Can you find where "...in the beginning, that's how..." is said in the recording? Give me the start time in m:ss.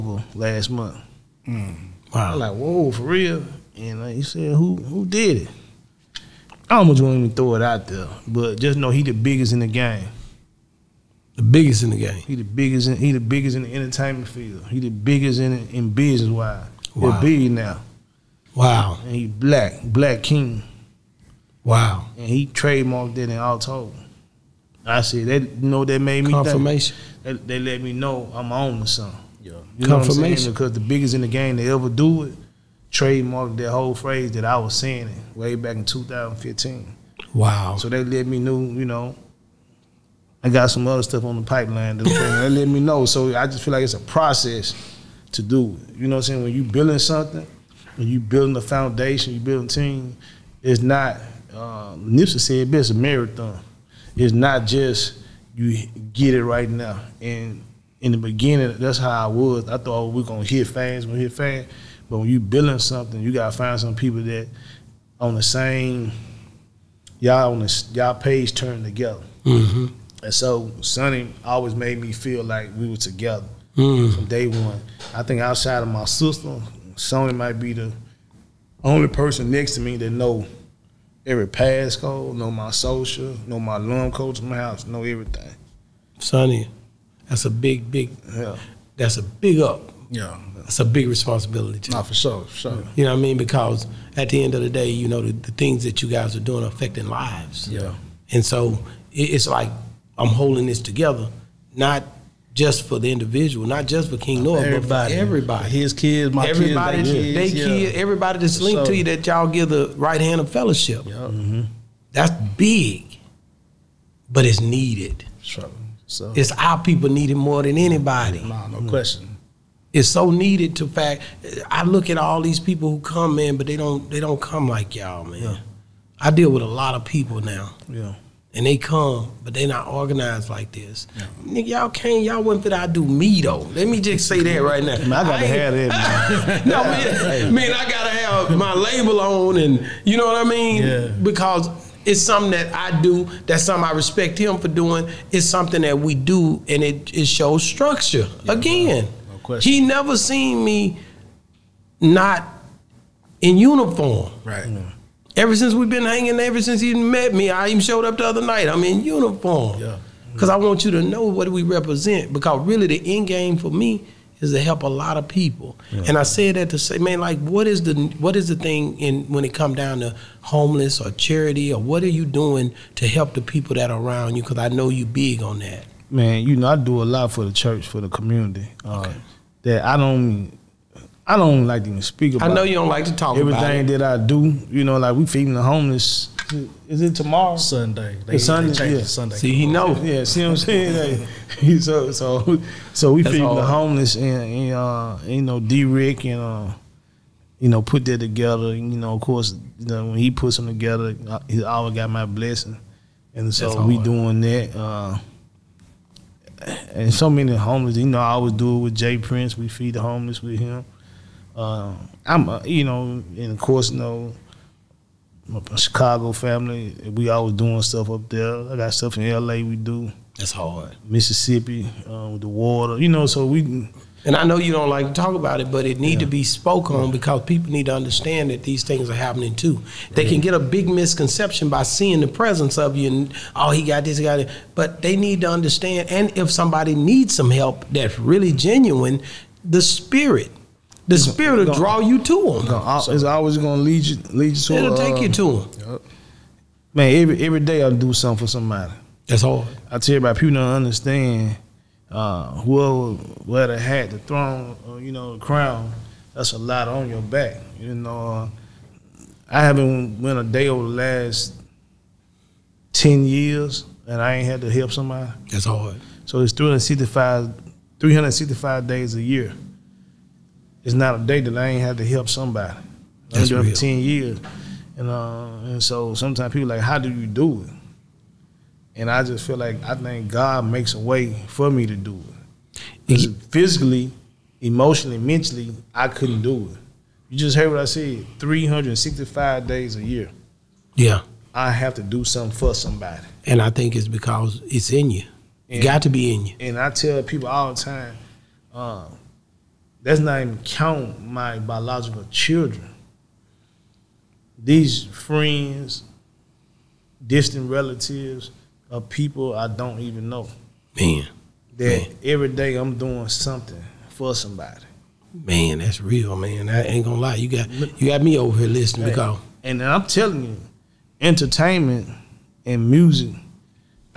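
0:57.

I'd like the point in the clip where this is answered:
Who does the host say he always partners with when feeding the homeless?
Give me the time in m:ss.
3:28.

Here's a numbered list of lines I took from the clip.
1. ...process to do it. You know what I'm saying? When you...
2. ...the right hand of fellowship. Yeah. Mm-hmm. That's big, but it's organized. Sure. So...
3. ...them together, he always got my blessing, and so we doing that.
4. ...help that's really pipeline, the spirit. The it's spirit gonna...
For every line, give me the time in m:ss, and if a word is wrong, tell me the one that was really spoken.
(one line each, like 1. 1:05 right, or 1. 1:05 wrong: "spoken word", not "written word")
1. 0:43 right
2. 1:49 wrong: "needed", not "organized"
3. 3:20 right
4. 3:57 wrong: "genuine", not "pipeline".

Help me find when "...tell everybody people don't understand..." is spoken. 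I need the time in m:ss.
4:09.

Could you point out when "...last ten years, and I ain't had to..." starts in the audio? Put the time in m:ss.
4:20.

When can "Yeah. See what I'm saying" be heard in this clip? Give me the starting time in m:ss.
3:10.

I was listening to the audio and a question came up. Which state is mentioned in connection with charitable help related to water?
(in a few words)
Mississippi.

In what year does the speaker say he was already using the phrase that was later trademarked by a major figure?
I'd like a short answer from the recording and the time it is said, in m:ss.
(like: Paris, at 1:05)
2015, at 0:35.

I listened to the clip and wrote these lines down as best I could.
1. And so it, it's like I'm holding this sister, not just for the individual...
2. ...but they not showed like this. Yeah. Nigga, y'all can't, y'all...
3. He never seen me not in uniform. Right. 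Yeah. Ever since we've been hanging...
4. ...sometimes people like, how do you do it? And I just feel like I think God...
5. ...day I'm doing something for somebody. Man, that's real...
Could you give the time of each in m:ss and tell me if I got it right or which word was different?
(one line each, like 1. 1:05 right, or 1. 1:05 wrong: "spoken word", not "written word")
1. 1:38 wrong: "together", not "sister"
2. 2:09 wrong: "organized", not "showed"
3. 2:29 right
4. 4:36 right
5. 5:12 right.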